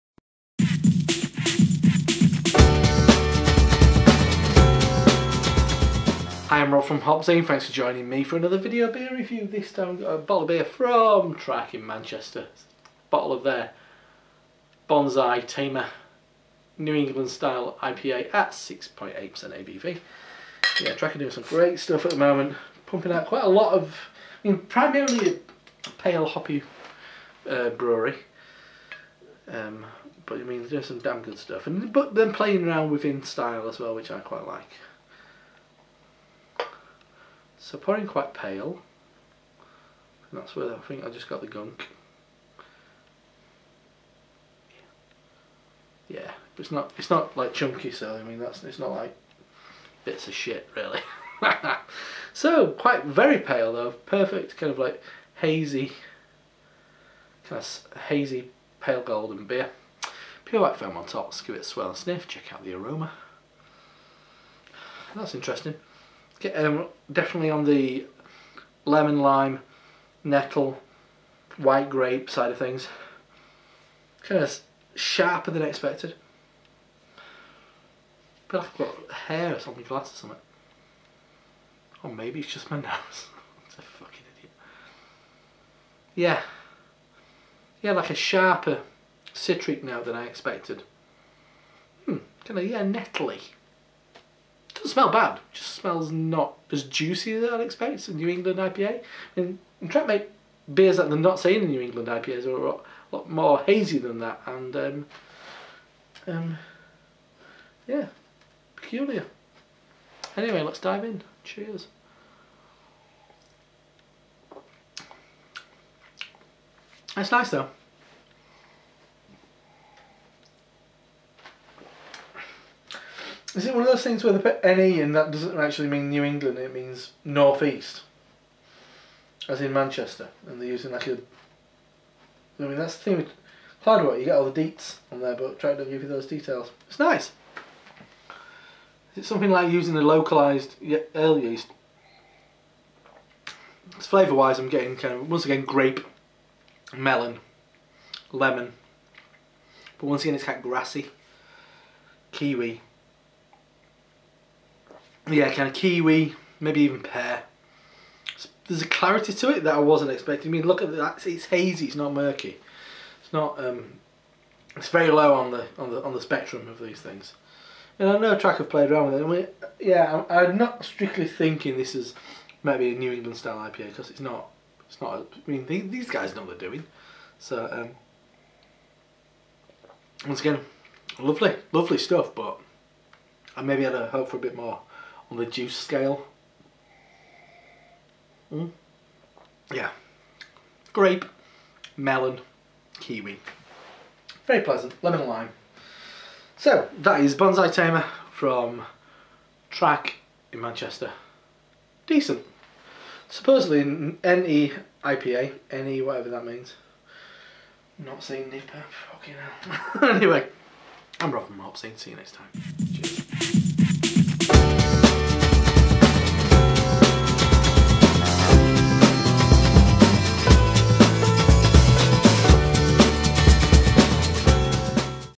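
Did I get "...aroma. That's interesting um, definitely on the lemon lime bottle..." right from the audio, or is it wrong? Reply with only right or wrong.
wrong.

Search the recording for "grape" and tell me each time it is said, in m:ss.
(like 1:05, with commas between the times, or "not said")
1:11, 2:25, 3:10.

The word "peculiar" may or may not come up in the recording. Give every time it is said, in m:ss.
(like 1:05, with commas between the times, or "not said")
1:48.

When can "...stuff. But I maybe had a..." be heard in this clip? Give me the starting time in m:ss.
3:01.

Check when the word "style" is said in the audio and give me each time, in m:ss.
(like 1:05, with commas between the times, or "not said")
0:17, 0:33, 2:53.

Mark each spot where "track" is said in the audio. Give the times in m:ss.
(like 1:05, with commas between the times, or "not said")
0:11, 0:20, 2:15, 2:48, 3:19.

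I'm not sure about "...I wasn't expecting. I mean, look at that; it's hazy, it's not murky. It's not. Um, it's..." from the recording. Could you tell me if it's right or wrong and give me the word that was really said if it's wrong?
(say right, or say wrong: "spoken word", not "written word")
right.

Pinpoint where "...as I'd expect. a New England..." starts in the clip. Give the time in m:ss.
1:37.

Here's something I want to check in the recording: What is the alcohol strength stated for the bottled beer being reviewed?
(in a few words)
6.8%.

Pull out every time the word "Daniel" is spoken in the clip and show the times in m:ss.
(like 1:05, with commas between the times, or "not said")
not said.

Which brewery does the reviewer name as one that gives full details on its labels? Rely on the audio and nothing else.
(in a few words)
Cloudwater.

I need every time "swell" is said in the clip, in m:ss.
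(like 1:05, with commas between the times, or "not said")
1:01.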